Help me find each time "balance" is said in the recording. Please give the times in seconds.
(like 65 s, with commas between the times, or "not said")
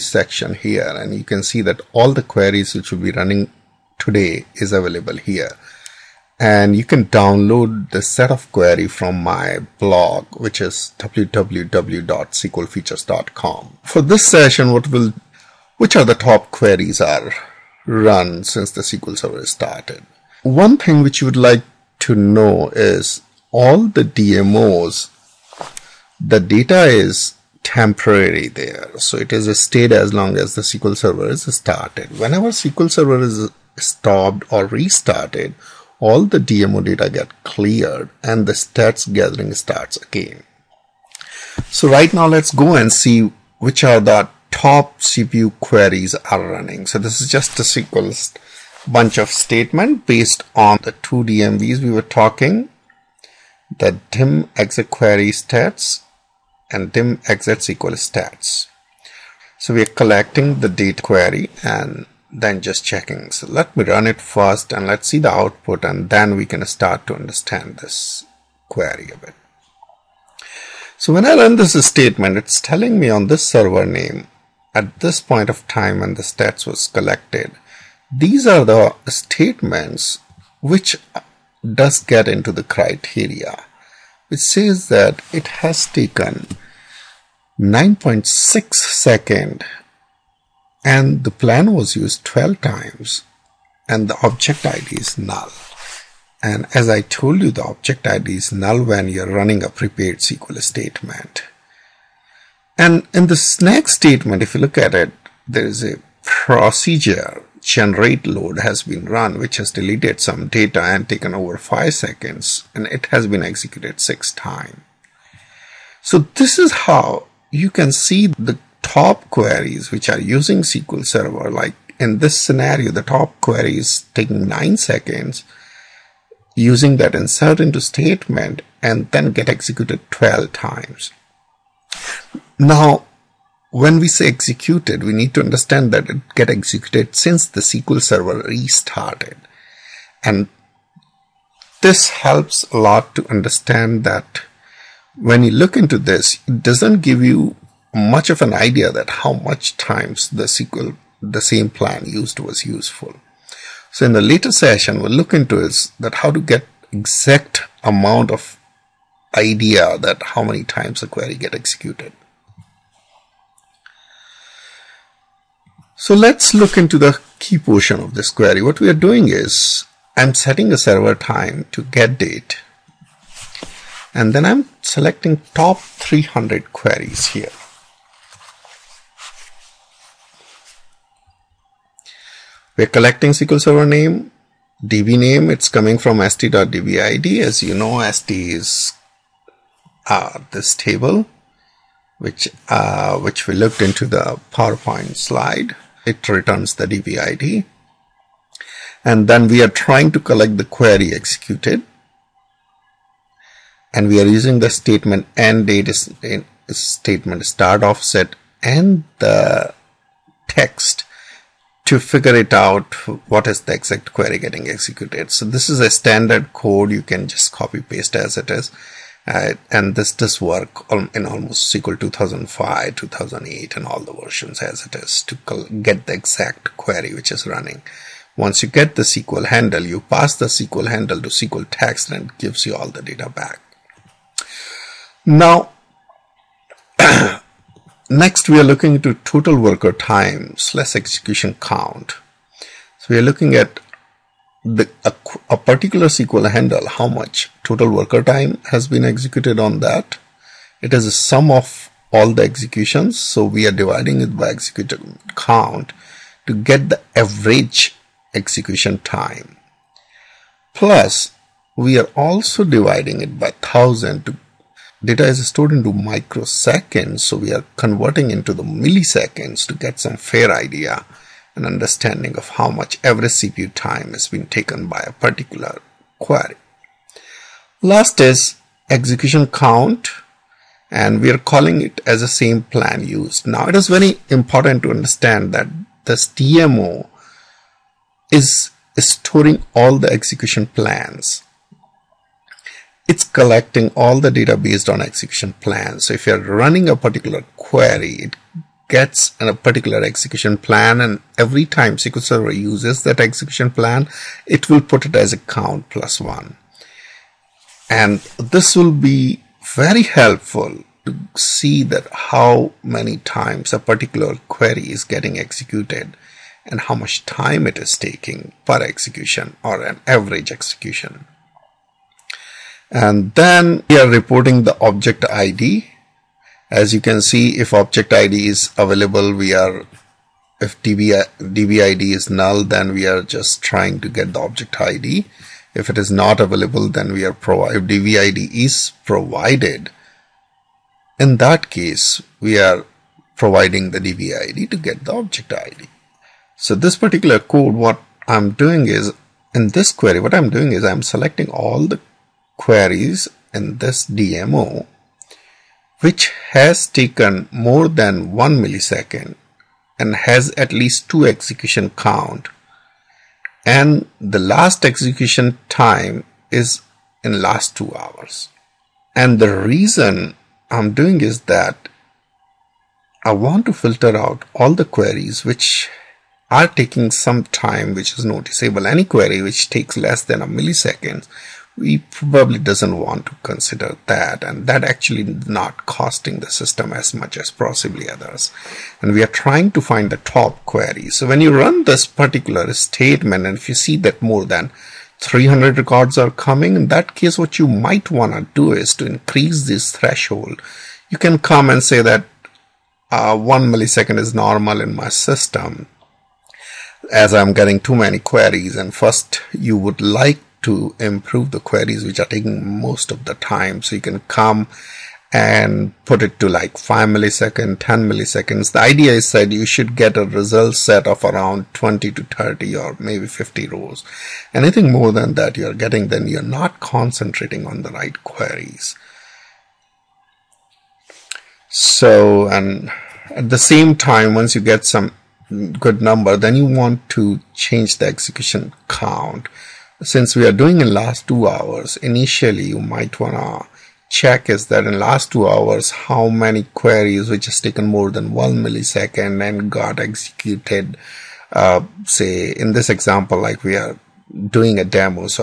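not said.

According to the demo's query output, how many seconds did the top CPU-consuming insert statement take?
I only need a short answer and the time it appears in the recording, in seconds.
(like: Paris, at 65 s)
9.6 seconds, at 87 s.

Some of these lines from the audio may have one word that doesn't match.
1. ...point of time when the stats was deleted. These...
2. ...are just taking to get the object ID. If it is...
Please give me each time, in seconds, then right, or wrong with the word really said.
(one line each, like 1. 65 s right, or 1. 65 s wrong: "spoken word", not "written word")
1. 75 s wrong: "collected", not "deleted"
2. 333 s wrong: "trying", not "taking".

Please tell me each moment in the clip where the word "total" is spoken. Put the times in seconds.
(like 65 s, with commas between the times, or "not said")
239 s, 247 s.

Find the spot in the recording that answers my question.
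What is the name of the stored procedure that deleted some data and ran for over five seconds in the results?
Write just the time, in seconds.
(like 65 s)
107 s.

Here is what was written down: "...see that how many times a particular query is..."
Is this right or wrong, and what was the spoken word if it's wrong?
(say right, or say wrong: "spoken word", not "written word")
right.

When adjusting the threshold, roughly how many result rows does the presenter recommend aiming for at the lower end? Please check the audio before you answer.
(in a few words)
20 to 30.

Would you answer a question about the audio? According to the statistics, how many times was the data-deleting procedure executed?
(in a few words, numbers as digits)
6.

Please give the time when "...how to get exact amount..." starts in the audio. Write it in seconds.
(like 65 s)
156 s.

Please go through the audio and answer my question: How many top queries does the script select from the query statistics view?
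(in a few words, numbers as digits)
300.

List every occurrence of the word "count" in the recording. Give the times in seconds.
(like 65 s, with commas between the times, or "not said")
241 s, 255 s, 279 s, 305 s, 361 s, 438 s.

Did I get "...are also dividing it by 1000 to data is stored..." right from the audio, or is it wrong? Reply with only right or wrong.
right.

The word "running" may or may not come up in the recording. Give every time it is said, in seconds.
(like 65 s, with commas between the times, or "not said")
3 s, 46 s, 99 s, 227 s, 296 s.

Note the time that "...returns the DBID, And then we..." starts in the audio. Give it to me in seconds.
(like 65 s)
196 s.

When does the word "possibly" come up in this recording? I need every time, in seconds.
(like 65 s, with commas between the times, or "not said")
387 s.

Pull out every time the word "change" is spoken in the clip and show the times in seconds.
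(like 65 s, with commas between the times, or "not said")
437 s.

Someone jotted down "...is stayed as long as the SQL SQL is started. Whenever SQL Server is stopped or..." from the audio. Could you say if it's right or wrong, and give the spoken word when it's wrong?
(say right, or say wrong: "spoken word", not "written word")
wrong: "Server", not "SQL".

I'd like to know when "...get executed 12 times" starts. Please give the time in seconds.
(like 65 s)
129 s.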